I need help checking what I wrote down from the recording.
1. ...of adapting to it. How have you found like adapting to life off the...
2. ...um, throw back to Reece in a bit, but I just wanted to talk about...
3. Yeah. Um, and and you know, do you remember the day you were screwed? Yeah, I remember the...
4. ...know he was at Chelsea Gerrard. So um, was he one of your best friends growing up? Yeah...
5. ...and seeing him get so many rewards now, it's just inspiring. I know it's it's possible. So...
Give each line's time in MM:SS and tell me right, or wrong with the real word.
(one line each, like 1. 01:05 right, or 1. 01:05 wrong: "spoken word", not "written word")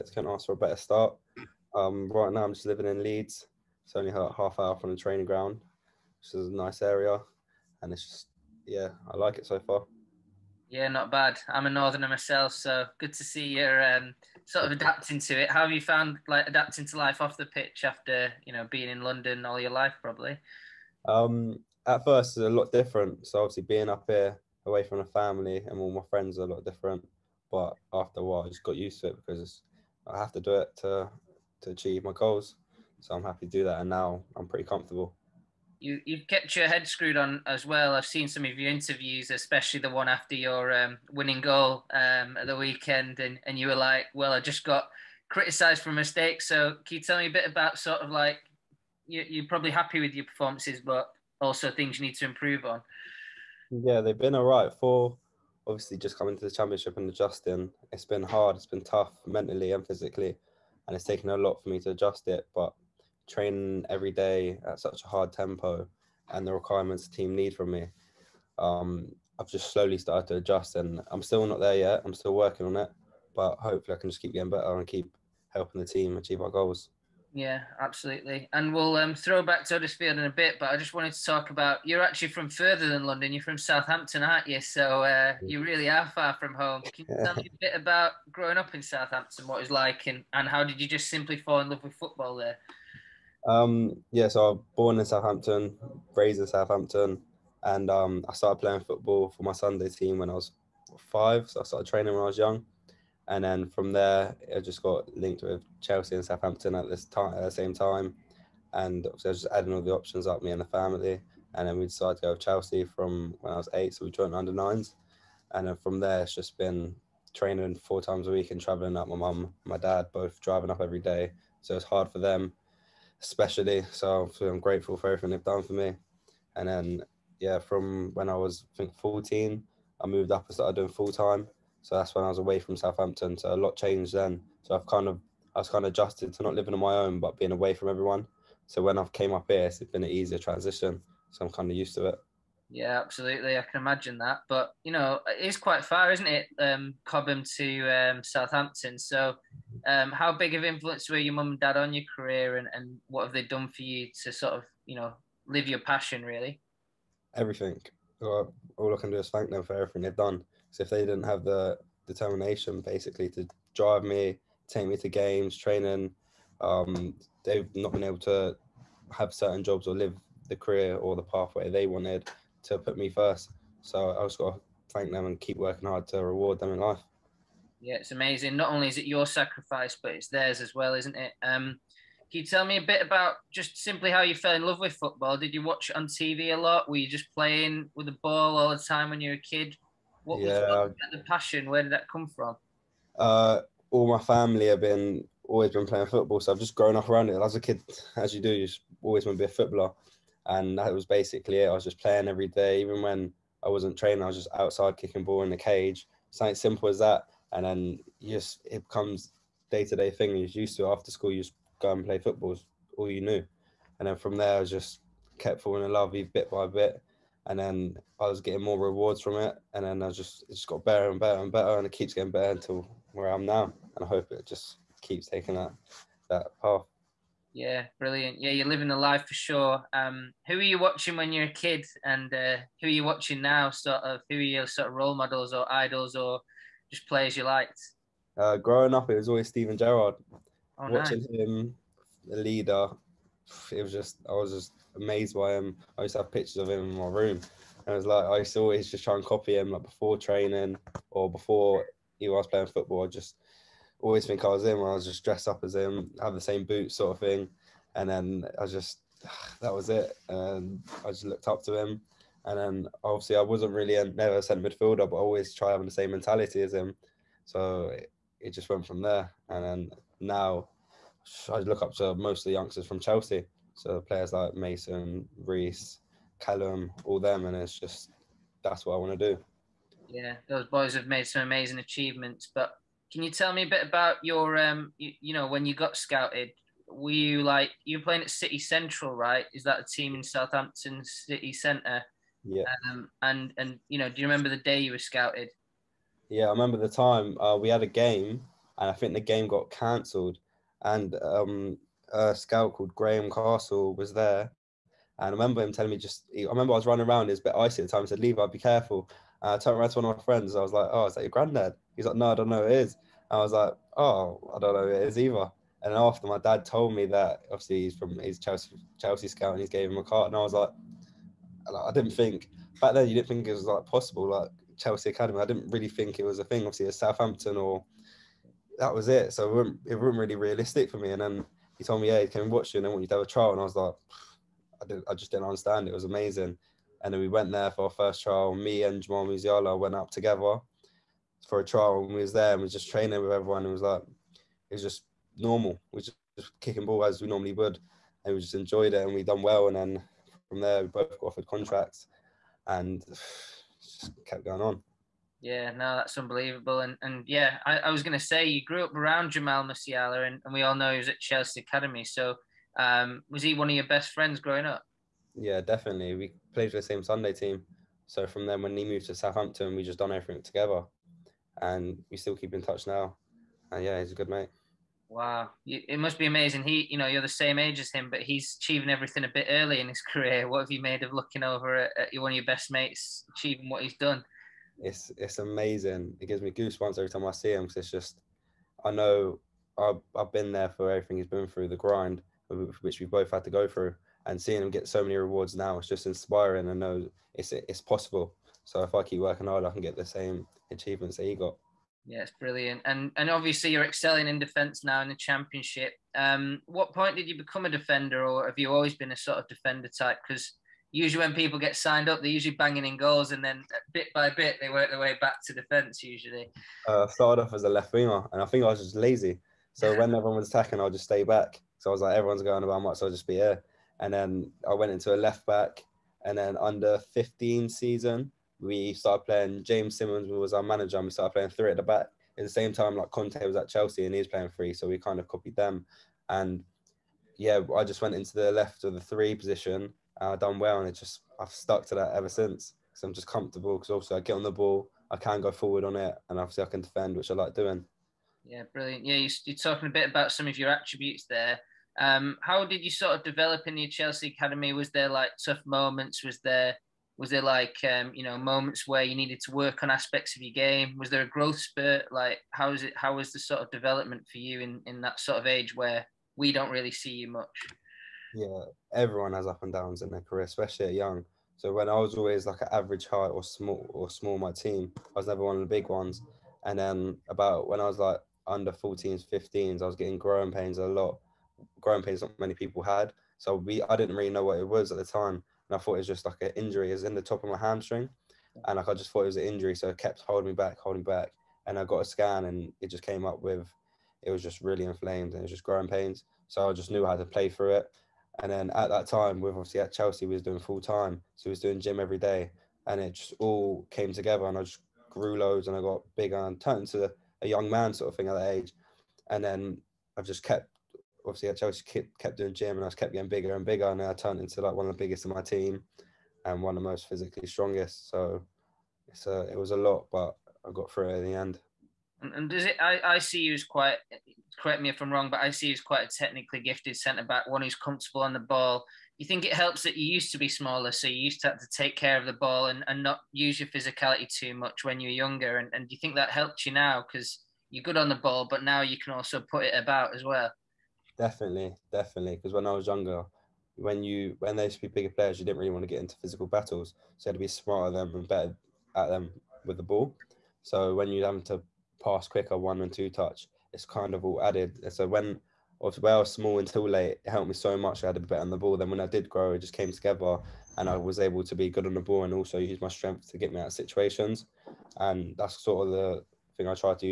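1. 00:14 right
2. 01:18 wrong: "Huddersfield", not "Reece"
3. 04:52 wrong: "scouted", not "screwed"
4. 06:00 wrong: "Academy", not "Gerrard"
5. 06:34 right.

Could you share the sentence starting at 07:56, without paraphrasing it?
And then about when I was like under 14s, 15s, I was getting growing pains a lot.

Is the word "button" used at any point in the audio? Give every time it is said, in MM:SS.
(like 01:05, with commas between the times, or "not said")
not said.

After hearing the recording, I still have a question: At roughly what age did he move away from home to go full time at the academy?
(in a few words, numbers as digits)
14.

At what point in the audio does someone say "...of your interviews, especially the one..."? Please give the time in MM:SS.
00:38.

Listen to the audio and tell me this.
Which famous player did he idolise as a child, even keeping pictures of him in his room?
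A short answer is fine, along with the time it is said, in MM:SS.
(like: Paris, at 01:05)
Steven Gerrard, at 03:59.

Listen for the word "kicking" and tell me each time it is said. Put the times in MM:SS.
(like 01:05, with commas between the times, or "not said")
03:24, 05:46.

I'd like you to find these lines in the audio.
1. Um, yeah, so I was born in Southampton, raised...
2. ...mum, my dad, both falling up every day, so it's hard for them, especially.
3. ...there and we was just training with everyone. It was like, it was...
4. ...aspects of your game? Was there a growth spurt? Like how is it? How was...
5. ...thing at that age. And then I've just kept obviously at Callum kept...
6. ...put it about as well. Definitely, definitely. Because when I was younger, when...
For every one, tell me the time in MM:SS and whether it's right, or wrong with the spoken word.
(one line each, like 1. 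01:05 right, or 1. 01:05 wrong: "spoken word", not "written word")
1. 01:33 right
2. 01:59 wrong: "driving", not "falling"
3. 05:42 right
4. 07:39 right
5. 08:28 wrong: "Chelsea", not "Callum"
6. 08:59 right.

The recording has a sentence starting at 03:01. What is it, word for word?
Um, can you tell me a bit about just simply how you fell in love with football?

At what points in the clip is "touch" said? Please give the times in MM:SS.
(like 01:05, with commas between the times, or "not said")
06:12, 09:13.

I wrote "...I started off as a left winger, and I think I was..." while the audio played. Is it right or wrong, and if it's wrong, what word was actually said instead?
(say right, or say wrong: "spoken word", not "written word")
right.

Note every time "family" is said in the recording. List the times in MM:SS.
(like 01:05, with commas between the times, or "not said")
00:25, 01:50, 03:14.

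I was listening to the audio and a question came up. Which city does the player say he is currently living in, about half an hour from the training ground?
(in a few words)
Leeds.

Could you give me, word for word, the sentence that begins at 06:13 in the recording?
And yeah, he's a good mate.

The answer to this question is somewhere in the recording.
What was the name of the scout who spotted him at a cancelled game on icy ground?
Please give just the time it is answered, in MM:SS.
05:02.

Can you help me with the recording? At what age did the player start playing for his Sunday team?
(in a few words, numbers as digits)
5.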